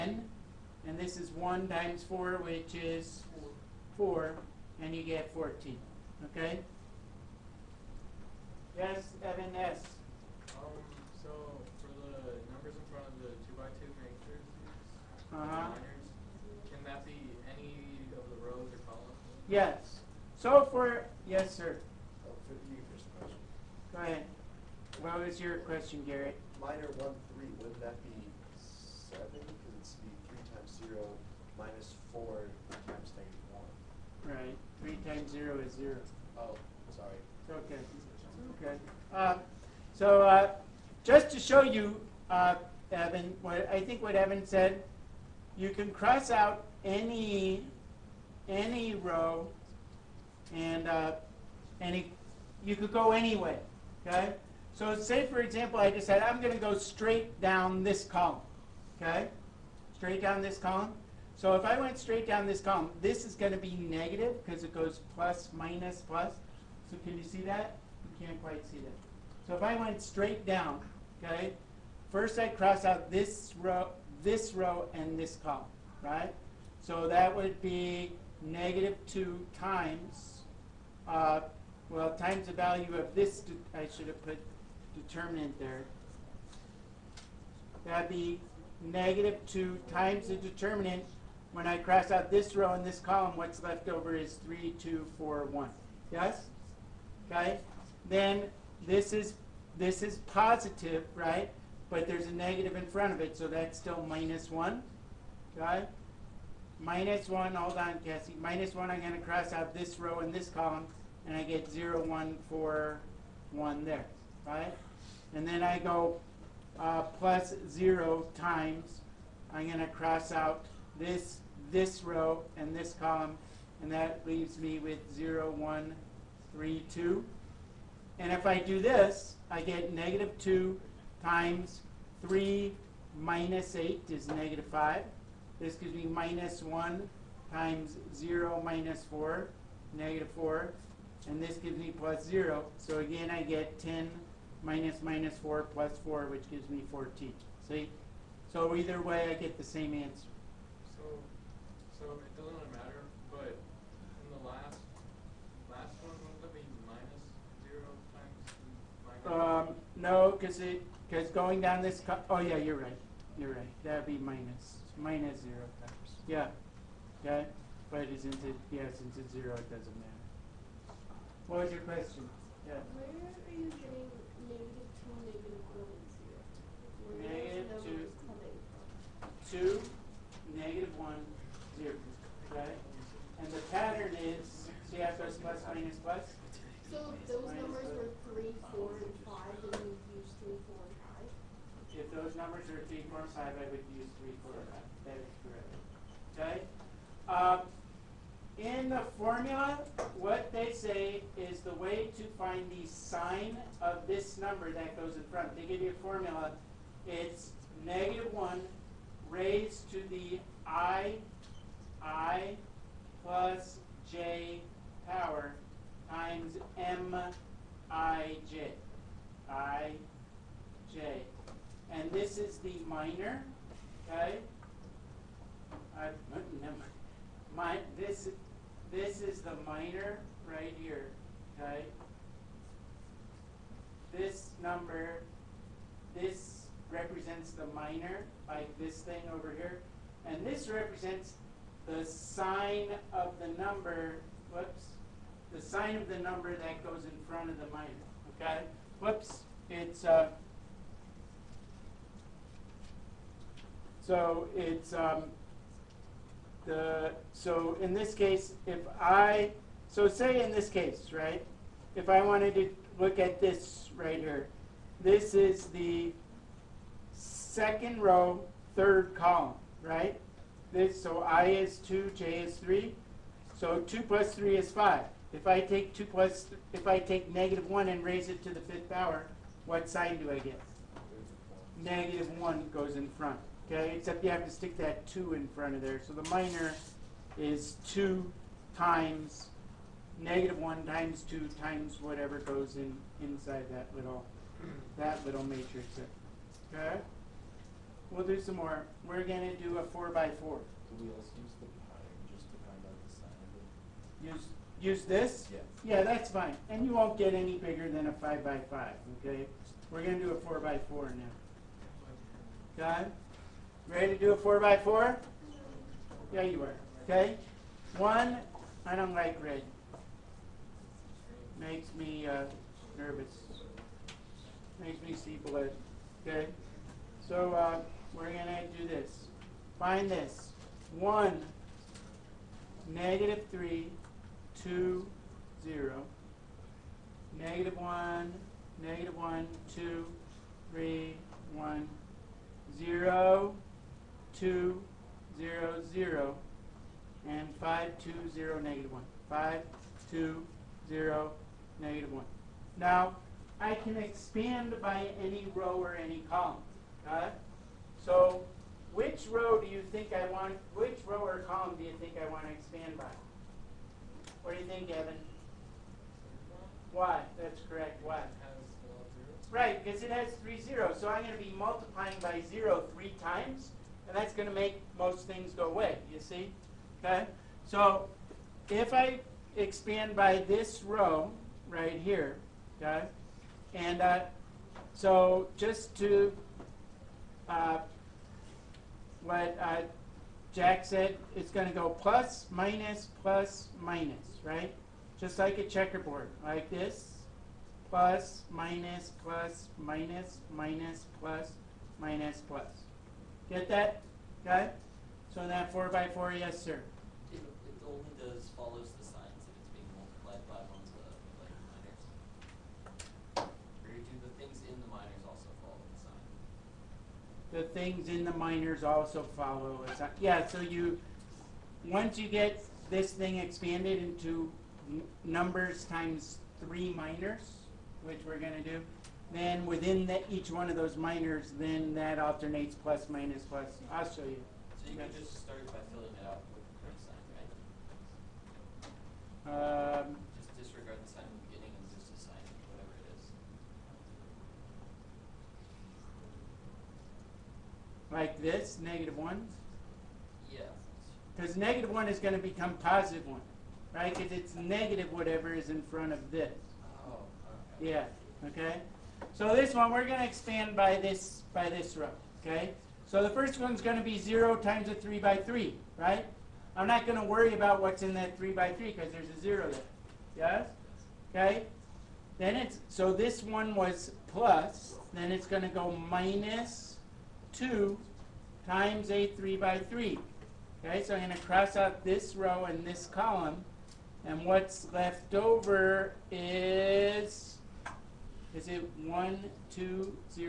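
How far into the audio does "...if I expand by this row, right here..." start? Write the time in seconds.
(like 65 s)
378 s.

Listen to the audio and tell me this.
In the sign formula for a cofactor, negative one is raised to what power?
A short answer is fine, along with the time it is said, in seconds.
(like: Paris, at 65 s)
i plus j, at 212 s.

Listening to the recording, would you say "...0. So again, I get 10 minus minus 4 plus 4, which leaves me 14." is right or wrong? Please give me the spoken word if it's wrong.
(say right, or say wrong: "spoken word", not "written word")
wrong: "gives", not "leaves".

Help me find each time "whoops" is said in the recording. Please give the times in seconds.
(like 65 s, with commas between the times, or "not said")
244 s, 249 s.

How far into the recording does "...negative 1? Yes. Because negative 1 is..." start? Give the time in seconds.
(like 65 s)
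448 s.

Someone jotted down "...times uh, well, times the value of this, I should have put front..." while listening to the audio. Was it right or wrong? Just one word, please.
wrong.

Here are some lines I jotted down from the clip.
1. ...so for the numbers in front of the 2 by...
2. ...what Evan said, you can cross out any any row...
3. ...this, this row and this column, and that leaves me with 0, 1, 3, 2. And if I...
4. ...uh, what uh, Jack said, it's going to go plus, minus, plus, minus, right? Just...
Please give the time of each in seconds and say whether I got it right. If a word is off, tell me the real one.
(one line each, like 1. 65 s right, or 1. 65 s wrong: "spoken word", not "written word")
1. 11 s right
2. 44 s right
3. 120 s right
4. 387 s right.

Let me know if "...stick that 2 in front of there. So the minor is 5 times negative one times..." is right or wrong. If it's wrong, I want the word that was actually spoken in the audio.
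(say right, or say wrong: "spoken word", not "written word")
wrong: "2", not "5".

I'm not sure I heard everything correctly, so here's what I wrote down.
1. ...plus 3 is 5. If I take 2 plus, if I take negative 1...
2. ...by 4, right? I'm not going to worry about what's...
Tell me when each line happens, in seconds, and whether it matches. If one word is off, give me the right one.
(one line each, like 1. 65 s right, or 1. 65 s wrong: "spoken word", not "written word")
1. 274 s right
2. 465 s wrong: "3", not "4".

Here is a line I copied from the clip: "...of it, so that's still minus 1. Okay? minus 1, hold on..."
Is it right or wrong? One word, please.
right.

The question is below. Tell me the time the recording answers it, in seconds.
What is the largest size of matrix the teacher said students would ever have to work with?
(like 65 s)
308 s.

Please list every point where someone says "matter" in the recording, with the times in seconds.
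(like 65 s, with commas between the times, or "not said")
152 s, 169 s.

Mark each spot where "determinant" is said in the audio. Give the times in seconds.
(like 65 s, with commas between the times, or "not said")
84 s, 90 s.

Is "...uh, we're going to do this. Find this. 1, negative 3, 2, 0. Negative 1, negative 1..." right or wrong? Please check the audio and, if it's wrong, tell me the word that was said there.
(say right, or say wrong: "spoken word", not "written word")
right.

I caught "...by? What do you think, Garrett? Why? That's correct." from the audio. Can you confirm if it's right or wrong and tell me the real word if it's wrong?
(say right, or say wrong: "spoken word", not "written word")
wrong: "Evan", not "Garrett".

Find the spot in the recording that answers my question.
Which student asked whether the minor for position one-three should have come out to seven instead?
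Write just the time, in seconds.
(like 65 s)
26 s.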